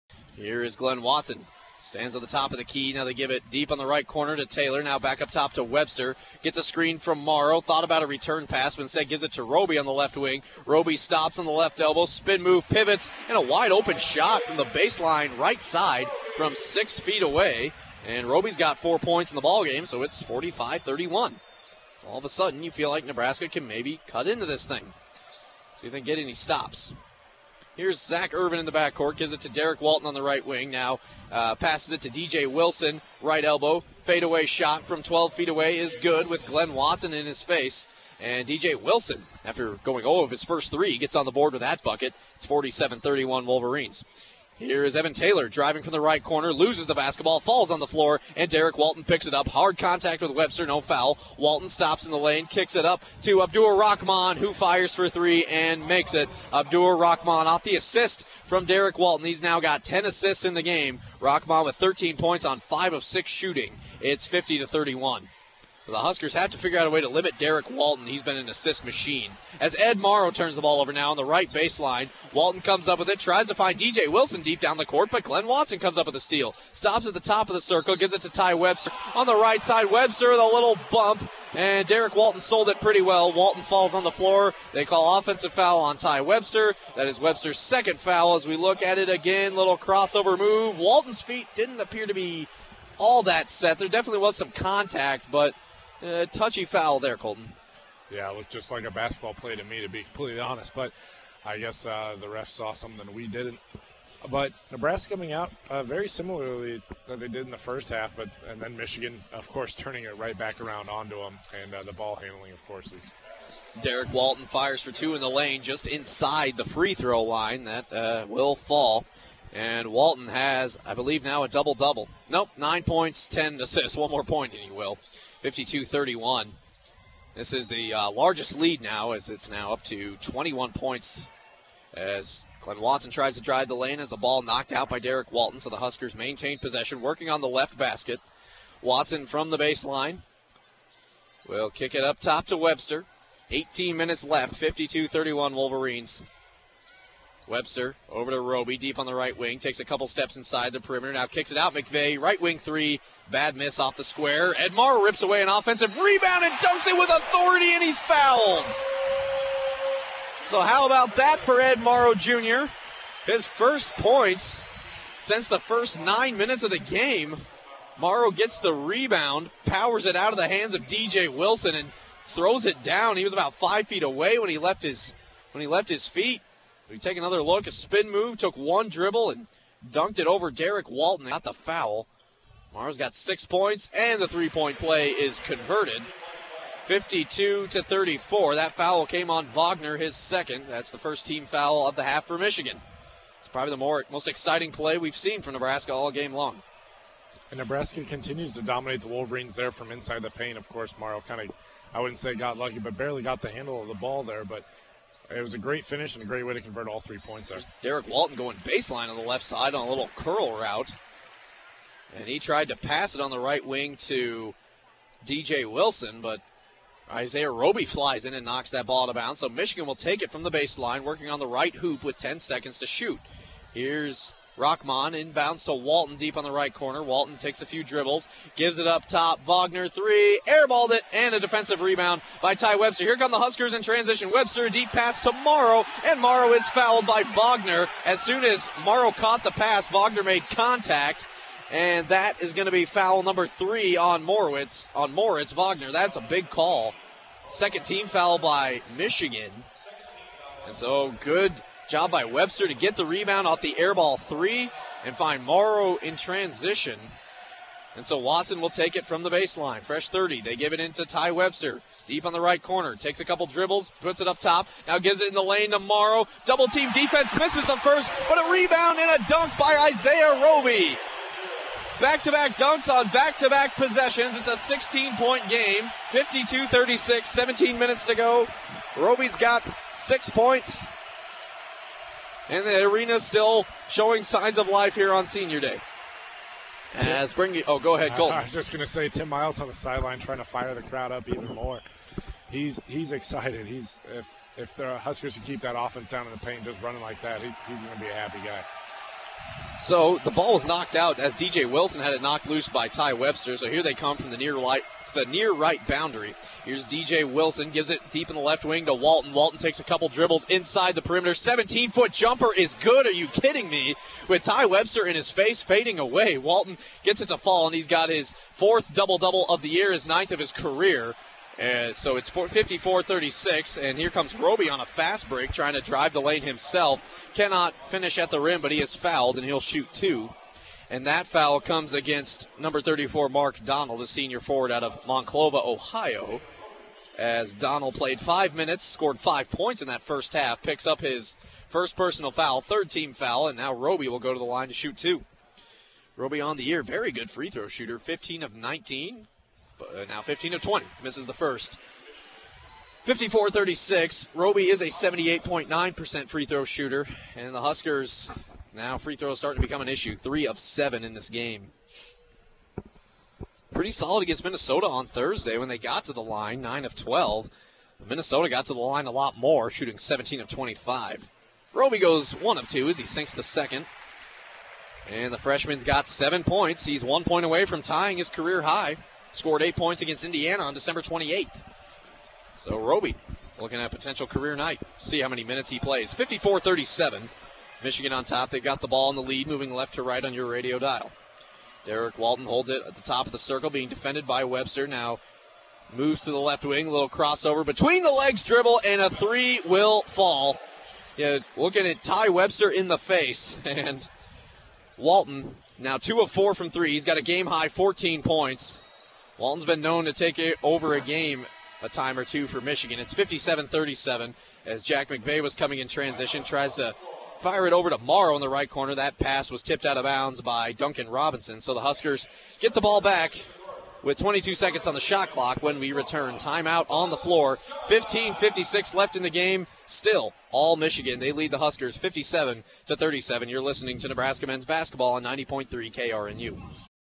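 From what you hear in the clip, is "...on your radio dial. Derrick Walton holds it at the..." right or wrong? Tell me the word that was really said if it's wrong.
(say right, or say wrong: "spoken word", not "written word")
right.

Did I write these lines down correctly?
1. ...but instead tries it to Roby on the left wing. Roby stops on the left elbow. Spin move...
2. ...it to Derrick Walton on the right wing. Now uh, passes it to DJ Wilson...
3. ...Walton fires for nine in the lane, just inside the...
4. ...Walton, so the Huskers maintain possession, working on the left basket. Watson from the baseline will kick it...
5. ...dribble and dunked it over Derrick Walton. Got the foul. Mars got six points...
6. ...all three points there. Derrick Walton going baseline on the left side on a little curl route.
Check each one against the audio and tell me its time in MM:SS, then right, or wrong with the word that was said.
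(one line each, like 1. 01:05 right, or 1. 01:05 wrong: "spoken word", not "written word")
1. 00:08 wrong: "gives", not "tries"
2. 00:29 right
3. 01:54 wrong: "two", not "nine"
4. 02:15 right
5. 02:58 right
6. 03:26 right.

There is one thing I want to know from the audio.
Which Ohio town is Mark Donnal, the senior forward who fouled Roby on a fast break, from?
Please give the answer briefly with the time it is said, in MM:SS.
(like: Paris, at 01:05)
Monclova, at 05:35.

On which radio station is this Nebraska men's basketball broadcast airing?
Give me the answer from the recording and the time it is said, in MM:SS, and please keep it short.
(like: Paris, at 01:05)
90.3 KRNU, at 07:15.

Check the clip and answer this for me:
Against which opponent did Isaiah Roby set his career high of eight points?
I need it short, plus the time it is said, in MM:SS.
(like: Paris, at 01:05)
Indiana, at 06:20.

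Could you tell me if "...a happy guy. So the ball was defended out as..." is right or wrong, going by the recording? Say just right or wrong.
wrong.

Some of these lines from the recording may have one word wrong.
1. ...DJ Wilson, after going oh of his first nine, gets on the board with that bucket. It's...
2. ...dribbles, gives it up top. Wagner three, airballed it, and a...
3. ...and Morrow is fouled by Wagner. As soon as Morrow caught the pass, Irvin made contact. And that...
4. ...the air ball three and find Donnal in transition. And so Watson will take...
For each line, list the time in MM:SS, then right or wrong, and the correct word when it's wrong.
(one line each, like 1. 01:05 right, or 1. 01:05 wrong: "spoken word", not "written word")
1. 00:38 wrong: "three", not "nine"
2. 03:47 right
3. 03:56 wrong: "Wagner", not "Irvin"
4. 04:13 wrong: "Morrow", not "Donnal".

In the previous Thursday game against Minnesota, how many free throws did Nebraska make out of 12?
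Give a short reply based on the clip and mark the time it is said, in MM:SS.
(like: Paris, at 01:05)
9, at 06:06.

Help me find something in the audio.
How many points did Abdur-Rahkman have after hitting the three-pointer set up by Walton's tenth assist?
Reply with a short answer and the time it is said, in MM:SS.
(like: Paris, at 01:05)
13, at 01:01.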